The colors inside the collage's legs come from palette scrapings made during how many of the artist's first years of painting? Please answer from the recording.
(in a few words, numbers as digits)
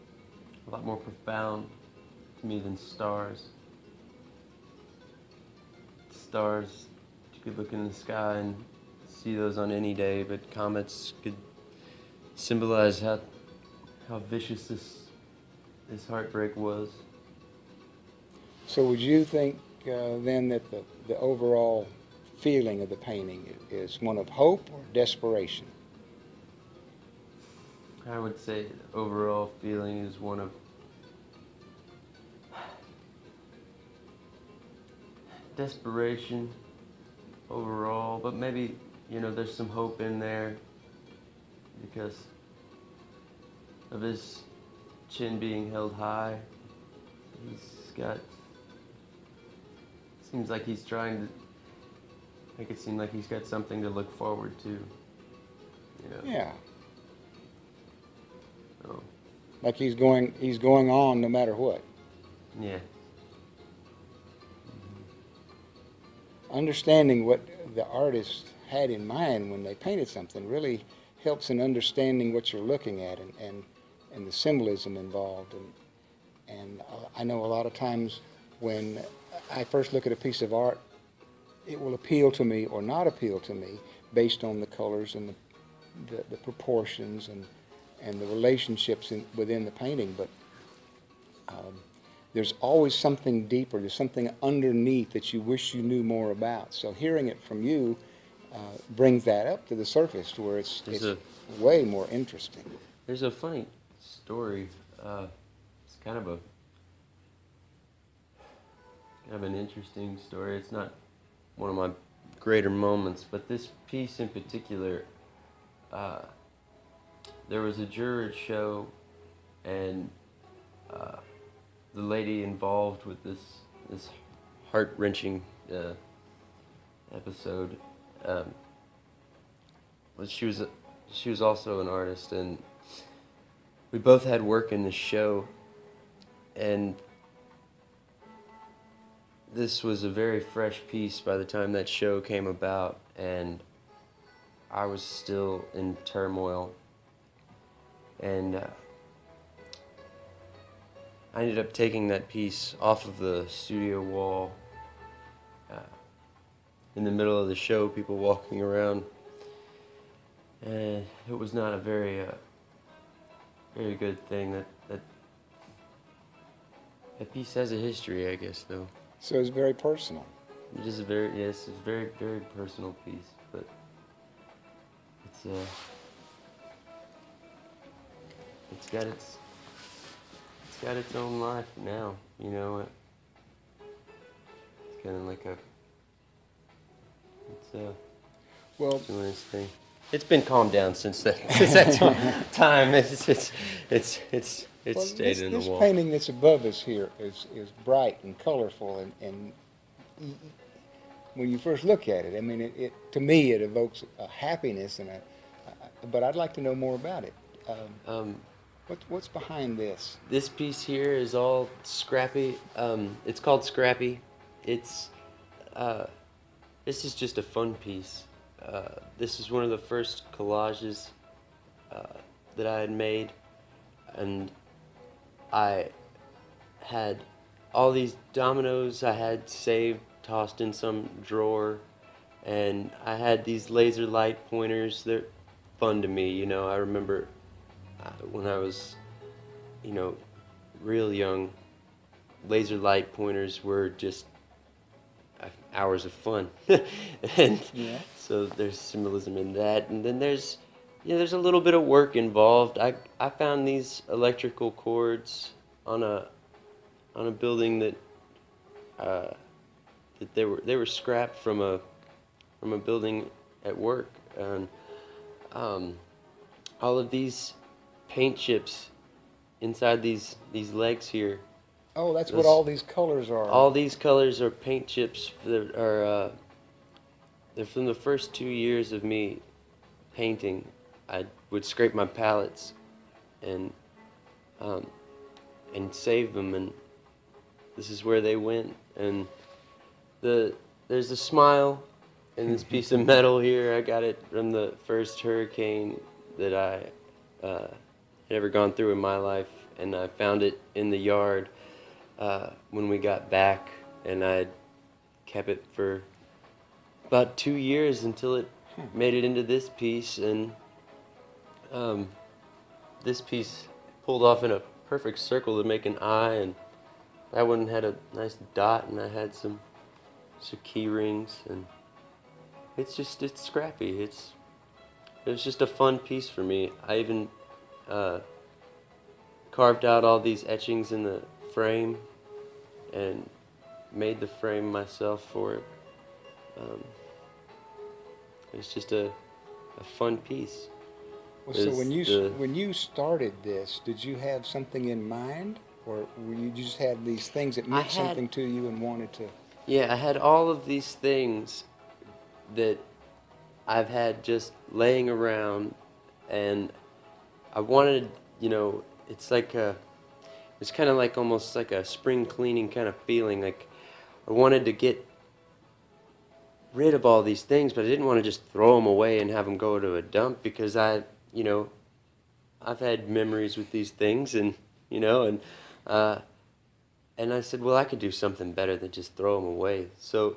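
2.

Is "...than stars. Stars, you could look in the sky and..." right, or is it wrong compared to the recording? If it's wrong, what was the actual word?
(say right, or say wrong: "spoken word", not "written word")
right.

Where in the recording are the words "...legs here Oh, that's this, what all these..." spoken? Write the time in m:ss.
4:30.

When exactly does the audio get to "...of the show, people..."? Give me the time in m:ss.
2:37.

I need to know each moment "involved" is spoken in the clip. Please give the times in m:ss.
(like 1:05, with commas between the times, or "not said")
1:14, 2:02, 4:12.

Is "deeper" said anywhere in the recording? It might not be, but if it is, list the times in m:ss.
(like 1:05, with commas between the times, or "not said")
1:33.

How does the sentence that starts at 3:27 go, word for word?
Um, um, what, what's behind this?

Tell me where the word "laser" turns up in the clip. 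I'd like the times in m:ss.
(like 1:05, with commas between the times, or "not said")
3:53, 4:02.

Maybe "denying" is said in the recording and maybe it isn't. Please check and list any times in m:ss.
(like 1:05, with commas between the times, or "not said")
not said.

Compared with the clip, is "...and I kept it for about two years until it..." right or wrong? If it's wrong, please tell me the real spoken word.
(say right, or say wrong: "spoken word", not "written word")
right.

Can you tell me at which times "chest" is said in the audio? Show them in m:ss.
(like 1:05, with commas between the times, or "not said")
not said.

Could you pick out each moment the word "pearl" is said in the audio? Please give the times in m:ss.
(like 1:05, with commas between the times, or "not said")
not said.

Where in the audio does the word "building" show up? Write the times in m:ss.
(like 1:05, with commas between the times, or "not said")
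4:17, 4:22.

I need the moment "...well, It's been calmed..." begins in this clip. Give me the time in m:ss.
3:08.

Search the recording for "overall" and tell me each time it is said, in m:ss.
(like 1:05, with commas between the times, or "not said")
0:21, 0:28, 0:37.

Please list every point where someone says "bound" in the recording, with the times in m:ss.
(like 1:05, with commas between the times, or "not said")
not said.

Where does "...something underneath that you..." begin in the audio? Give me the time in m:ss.
1:33.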